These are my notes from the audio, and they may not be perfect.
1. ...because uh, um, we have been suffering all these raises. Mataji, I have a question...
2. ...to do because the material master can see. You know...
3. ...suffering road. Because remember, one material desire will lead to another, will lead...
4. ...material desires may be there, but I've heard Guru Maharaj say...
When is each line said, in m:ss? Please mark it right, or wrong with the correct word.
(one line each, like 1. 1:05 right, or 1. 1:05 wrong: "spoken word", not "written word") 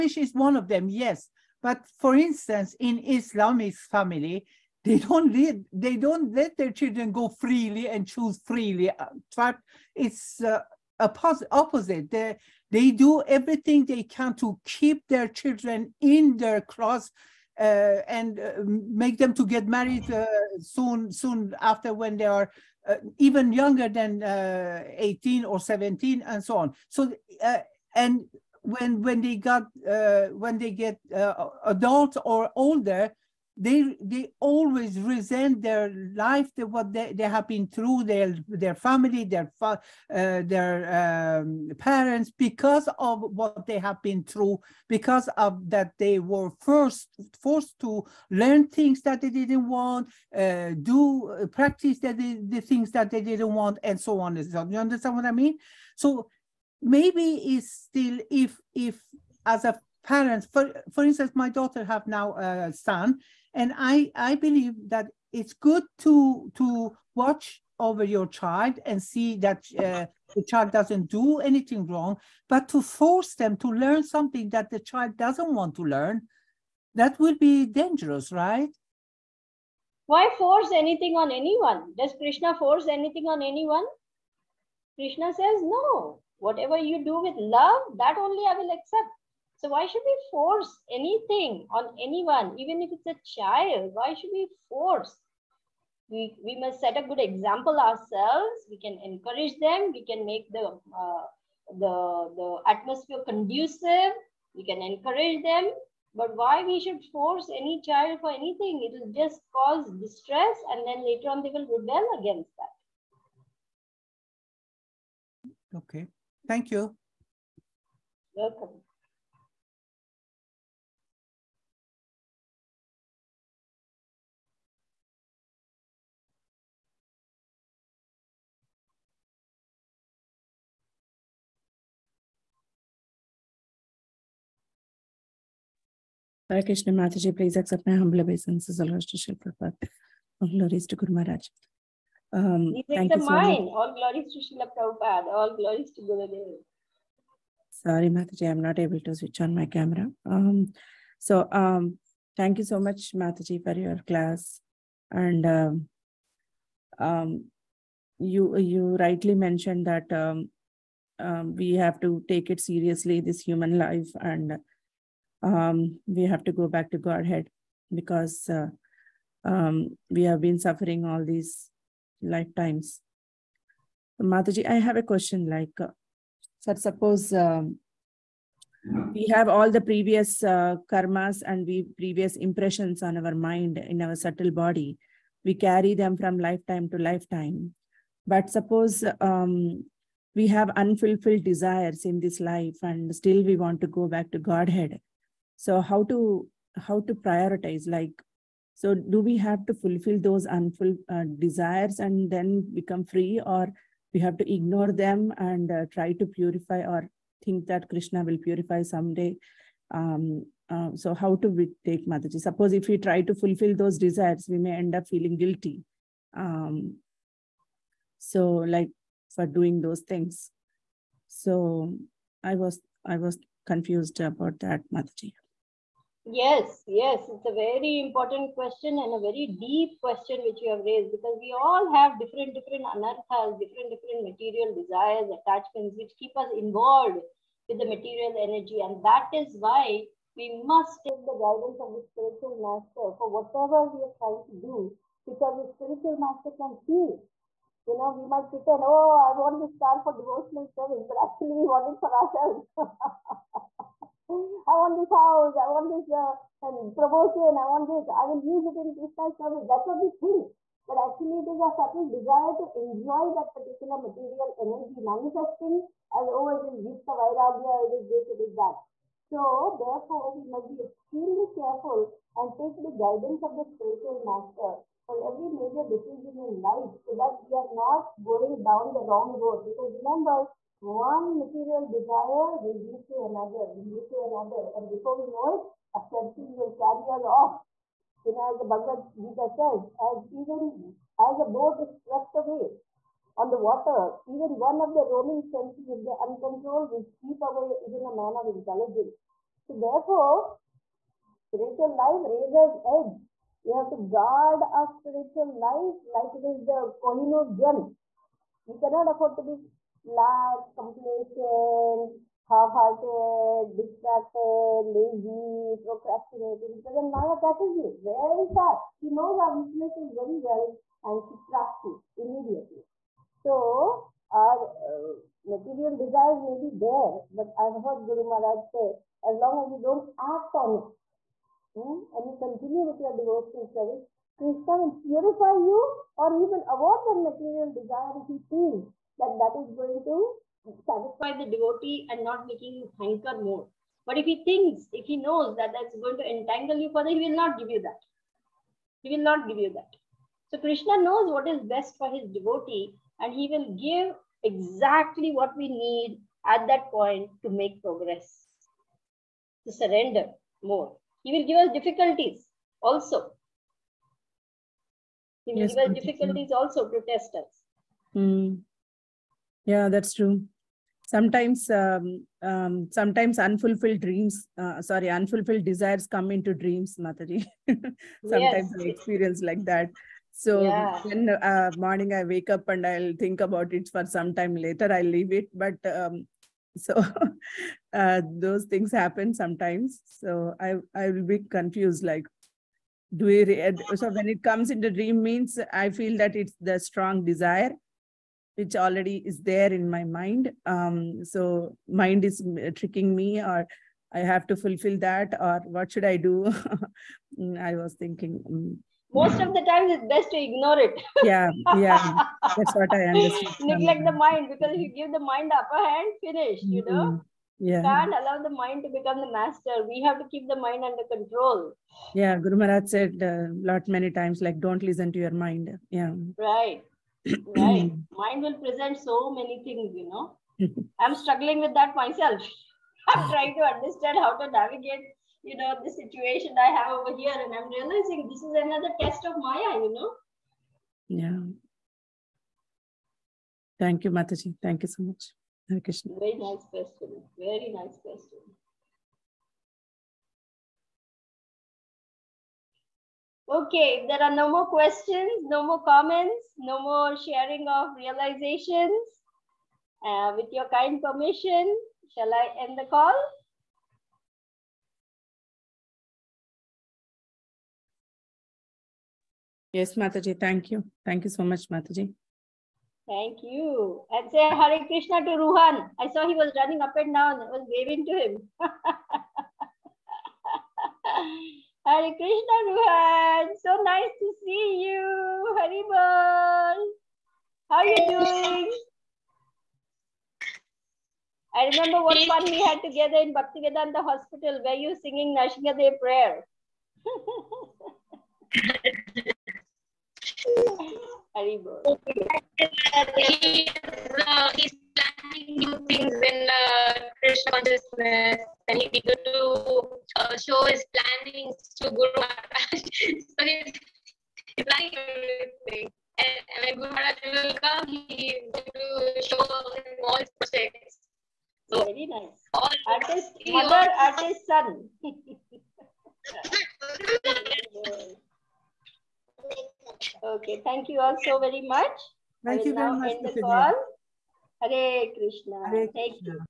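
1. 2:47 wrong: "lifetimes", not "raises"
2. 4:04 wrong: "spiritual", not "material"
3. 4:39 wrong: "wrong", not "suffering"
4. 5:25 right.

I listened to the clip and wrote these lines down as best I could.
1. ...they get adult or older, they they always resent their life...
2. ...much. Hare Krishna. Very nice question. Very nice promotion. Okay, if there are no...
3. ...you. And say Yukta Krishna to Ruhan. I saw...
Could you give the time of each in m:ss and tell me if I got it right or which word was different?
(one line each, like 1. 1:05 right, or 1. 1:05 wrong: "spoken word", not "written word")
1. 0:30 right
2. 7:25 wrong: "question", not "promotion"
3. 7:53 wrong: "Hare", not "Yukta".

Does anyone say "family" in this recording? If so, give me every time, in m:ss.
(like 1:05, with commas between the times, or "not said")
0:03, 0:38.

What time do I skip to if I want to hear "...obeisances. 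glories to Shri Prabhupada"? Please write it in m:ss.
2:18.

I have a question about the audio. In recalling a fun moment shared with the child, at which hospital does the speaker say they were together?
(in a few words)
Bhaktivedanta Hospital.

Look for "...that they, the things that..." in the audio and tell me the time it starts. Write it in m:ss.
0:51.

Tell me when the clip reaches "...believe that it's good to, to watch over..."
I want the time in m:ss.
1:04.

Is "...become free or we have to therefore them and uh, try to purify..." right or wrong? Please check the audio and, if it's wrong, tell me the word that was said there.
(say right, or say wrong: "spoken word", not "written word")
wrong: "ignore", not "therefore".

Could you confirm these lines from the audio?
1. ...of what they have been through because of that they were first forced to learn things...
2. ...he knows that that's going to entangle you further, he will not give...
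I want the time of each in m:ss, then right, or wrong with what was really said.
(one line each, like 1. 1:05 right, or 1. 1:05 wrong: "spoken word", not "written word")
1. 0:42 right
2. 5:45 right.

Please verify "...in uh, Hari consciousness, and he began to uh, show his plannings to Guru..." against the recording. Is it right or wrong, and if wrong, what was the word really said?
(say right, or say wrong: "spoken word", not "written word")
wrong: "Krishna", not "Hari".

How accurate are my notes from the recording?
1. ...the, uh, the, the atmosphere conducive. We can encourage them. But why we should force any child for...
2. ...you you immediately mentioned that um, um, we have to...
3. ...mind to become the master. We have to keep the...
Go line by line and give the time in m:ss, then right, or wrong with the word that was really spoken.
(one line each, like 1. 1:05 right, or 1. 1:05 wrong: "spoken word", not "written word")
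1. 1:40 right
2. 2:38 wrong: "rightly", not "immediately"
3. 6:58 right.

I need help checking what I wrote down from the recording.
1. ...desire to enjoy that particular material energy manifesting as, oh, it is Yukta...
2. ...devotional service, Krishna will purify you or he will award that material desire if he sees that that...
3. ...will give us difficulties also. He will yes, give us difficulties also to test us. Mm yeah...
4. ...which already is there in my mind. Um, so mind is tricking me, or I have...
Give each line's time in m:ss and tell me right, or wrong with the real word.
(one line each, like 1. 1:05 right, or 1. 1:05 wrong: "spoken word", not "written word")
1. 4:22 right
2. 5:33 right
3. 6:01 right
4. 6:38 right.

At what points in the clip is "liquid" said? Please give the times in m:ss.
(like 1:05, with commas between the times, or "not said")
not said.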